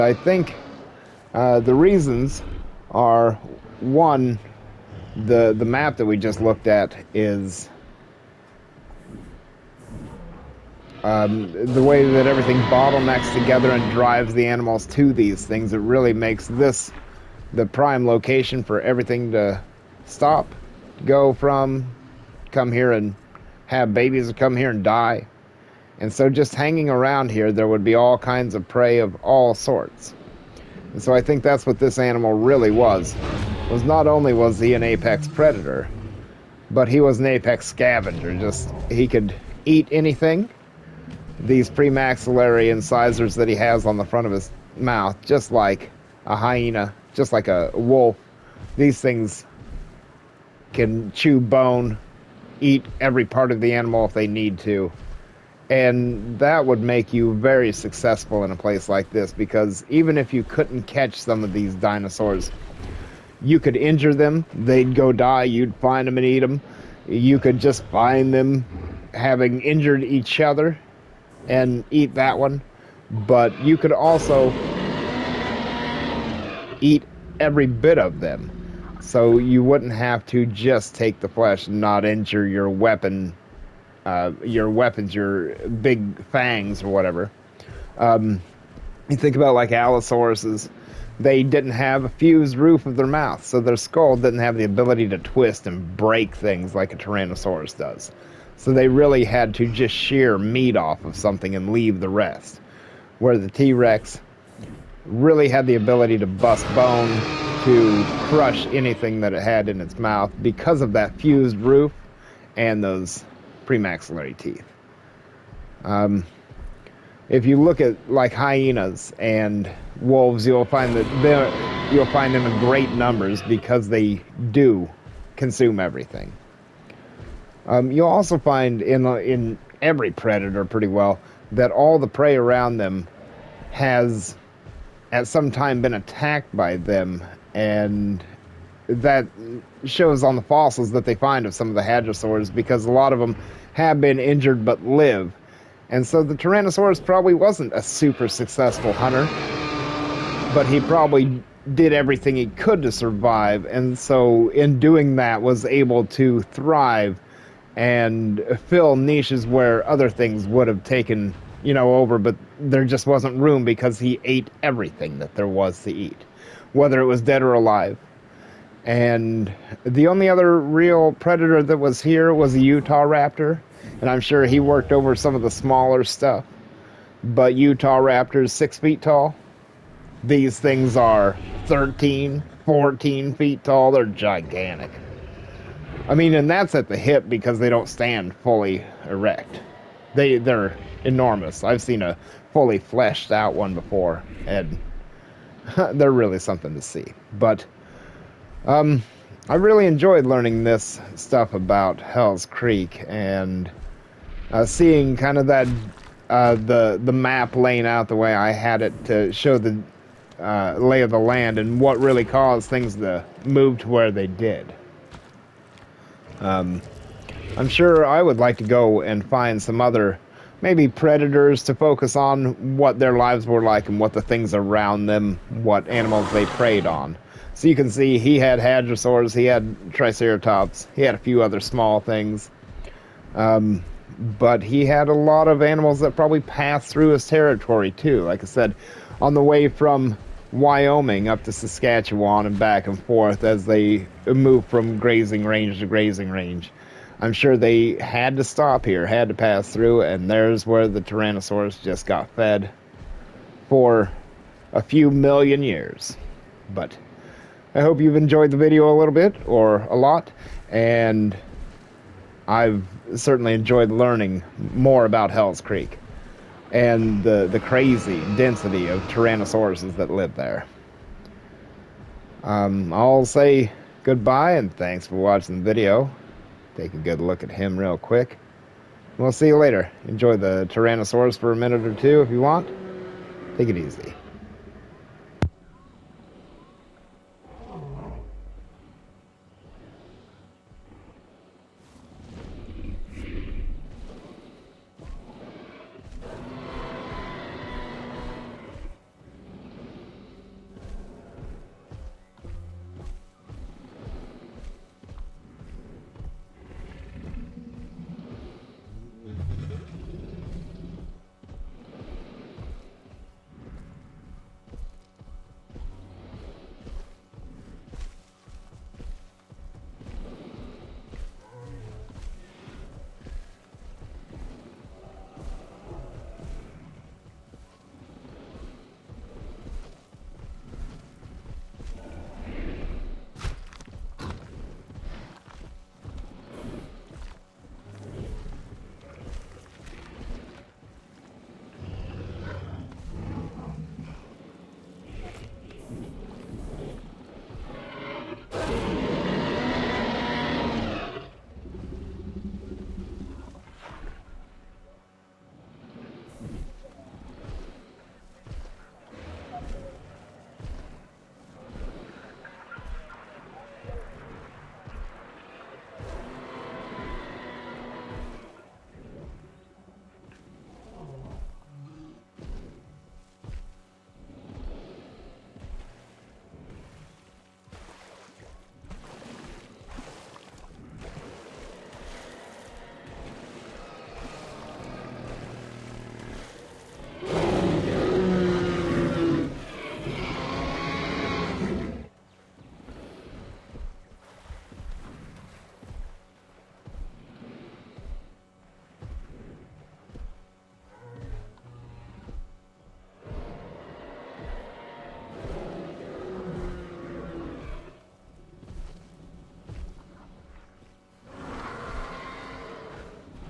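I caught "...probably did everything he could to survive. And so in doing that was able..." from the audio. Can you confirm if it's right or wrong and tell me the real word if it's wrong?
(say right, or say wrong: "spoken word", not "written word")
right.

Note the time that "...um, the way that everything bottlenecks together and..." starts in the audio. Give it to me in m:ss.
0:11.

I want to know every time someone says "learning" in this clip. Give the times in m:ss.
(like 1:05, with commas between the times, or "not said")
3:20, 4:23.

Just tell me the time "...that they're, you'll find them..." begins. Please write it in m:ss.
2:00.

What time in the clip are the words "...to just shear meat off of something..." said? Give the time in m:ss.
1:39.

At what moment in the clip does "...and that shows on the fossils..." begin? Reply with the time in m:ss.
2:17.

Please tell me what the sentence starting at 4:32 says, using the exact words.
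Um, I'll say goodbye and thanks for watching the video.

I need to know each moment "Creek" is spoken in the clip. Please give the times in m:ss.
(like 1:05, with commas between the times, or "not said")
3:22, 4:25.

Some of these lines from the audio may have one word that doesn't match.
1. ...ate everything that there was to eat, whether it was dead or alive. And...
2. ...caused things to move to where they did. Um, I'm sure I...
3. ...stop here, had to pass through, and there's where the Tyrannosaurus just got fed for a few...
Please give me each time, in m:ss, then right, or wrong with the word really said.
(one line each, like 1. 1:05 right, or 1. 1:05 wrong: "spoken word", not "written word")
1. 2:44 right
2. 3:32 right
3. 4:08 right.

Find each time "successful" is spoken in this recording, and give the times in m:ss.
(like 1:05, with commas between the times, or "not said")
0:57, 2:28.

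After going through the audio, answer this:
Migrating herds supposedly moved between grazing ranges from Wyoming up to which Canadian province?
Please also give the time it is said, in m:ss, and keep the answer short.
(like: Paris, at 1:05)
Saskatchewan, at 4:01.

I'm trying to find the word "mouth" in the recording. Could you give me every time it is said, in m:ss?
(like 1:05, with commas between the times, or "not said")
0:44, 1:33, 1:49.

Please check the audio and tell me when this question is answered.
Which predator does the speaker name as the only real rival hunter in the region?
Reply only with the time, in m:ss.
2:52.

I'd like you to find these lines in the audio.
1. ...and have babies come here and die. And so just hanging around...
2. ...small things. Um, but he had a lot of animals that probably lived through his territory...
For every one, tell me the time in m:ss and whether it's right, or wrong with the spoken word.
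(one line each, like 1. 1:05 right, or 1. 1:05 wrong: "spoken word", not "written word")
1. 0:22 right
2. 3:51 wrong: "passed", not "lived".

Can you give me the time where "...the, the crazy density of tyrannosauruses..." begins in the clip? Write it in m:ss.
4:27.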